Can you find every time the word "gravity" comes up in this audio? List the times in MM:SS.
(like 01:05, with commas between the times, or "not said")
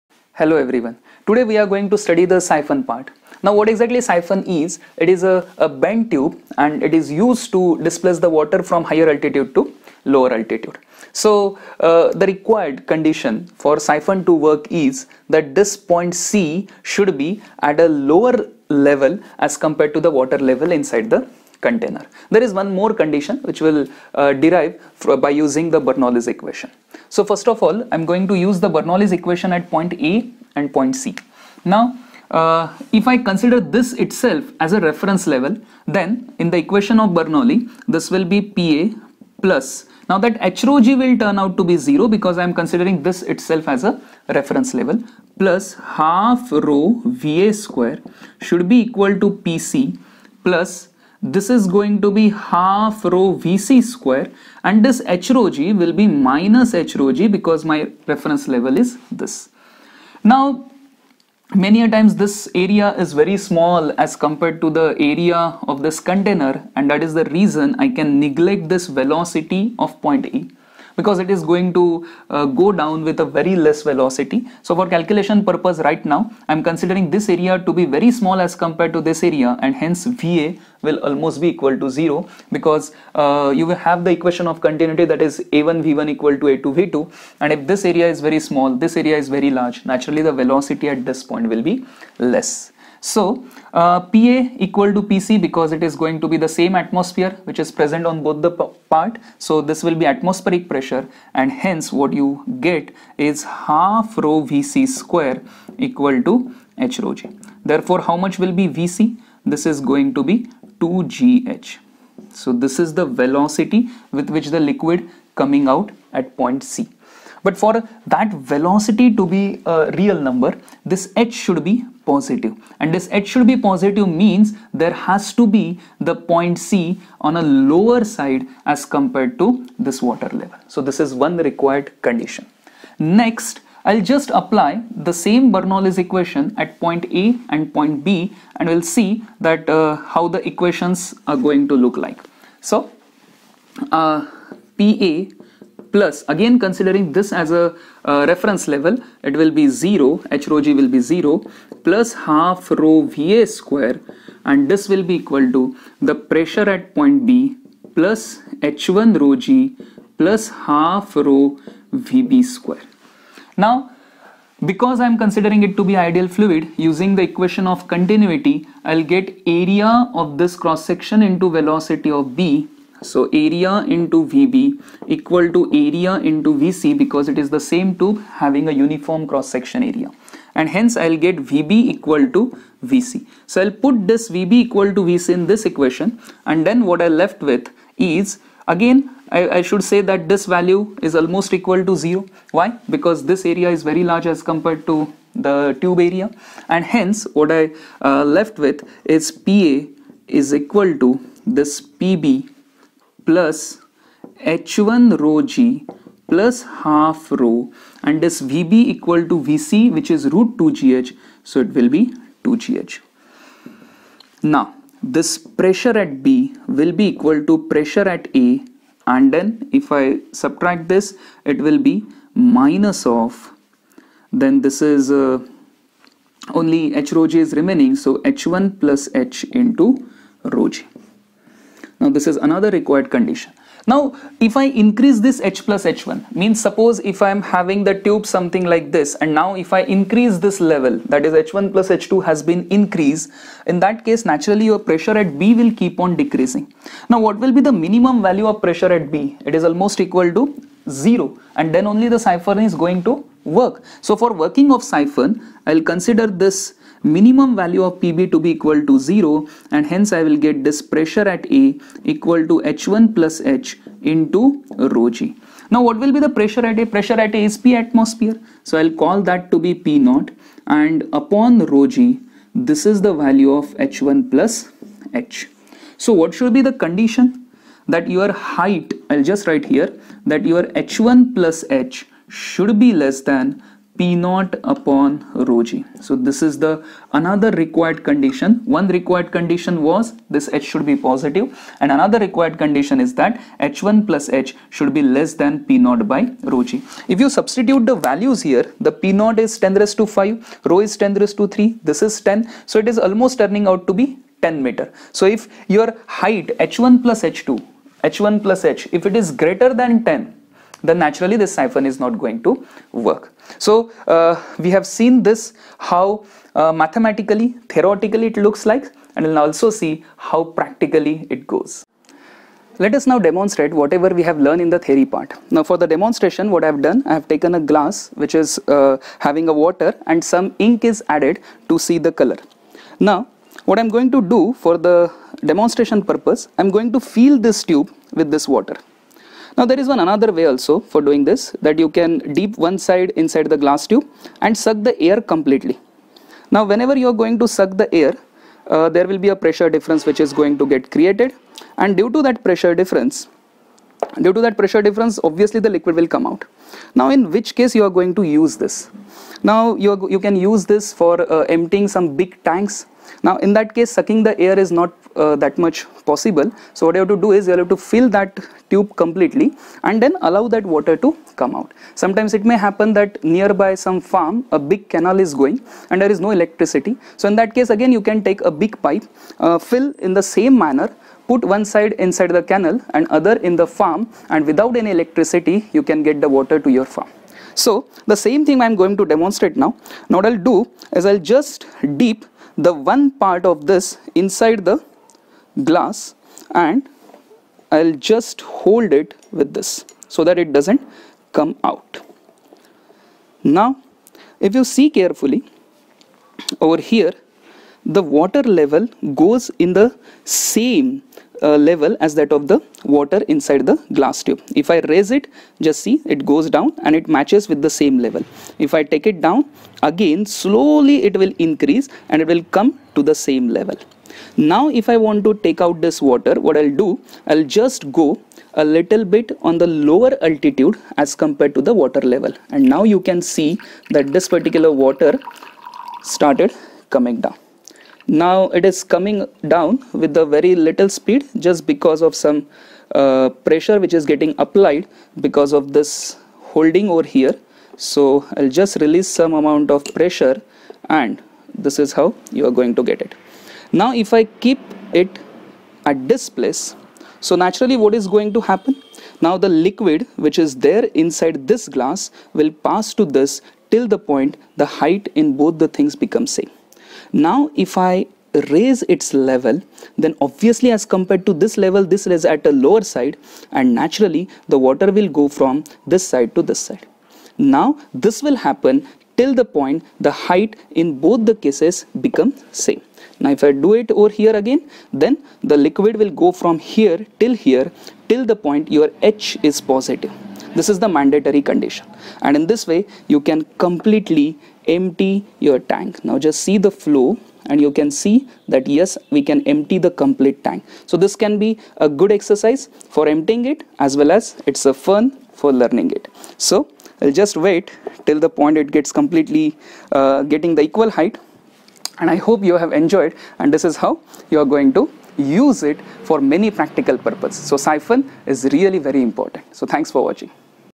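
not said.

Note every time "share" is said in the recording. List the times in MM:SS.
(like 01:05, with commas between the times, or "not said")
not said.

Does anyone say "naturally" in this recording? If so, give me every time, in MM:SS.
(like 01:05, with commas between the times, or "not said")
01:29, 04:04, 05:10, 07:37, 07:53.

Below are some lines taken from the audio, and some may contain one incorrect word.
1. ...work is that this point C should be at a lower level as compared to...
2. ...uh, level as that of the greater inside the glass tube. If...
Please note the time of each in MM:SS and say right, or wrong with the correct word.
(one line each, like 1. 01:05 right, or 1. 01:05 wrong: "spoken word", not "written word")
1. 00:14 right
2. 06:51 wrong: "water", not "greater".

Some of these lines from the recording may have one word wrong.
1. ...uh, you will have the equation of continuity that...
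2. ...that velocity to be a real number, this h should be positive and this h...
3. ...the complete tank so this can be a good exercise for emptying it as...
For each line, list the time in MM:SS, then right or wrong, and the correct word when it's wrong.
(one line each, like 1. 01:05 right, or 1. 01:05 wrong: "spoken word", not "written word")
1. 01:23 right
2. 01:58 right
3. 08:19 right.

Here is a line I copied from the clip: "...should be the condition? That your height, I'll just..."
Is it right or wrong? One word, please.
right.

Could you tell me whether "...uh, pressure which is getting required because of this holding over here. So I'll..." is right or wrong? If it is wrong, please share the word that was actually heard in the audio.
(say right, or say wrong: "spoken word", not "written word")
wrong: "applied", not "required".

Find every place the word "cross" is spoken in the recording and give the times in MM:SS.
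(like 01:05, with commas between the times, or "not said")
02:50, 02:59.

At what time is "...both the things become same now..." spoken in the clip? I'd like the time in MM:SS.
07:45.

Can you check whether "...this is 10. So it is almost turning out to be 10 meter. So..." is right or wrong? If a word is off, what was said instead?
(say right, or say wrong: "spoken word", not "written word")
right.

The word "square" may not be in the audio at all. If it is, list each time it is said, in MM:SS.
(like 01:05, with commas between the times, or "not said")
00:47, 00:53, 01:44, 02:33, 02:42.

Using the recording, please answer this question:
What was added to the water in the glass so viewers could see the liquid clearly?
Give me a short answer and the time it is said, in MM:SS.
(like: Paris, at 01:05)
ink, at 05:30.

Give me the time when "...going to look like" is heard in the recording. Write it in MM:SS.
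02:21.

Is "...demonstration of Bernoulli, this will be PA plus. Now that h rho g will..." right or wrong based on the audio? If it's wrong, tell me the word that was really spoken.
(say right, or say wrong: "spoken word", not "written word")
wrong: "equation", not "demonstration".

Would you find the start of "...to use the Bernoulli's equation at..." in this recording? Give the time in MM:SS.
00:28.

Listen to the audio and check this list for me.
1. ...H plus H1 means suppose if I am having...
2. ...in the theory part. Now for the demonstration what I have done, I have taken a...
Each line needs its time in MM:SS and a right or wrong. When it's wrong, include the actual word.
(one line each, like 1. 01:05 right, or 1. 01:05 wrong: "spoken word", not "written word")
1. 03:55 right
2. 05:24 right.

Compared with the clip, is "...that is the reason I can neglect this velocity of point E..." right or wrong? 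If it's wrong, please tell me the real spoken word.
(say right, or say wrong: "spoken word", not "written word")
right.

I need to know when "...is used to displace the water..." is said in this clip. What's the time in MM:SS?
00:06.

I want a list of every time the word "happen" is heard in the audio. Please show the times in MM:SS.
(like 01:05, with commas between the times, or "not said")
06:12, 07:38, 07:58.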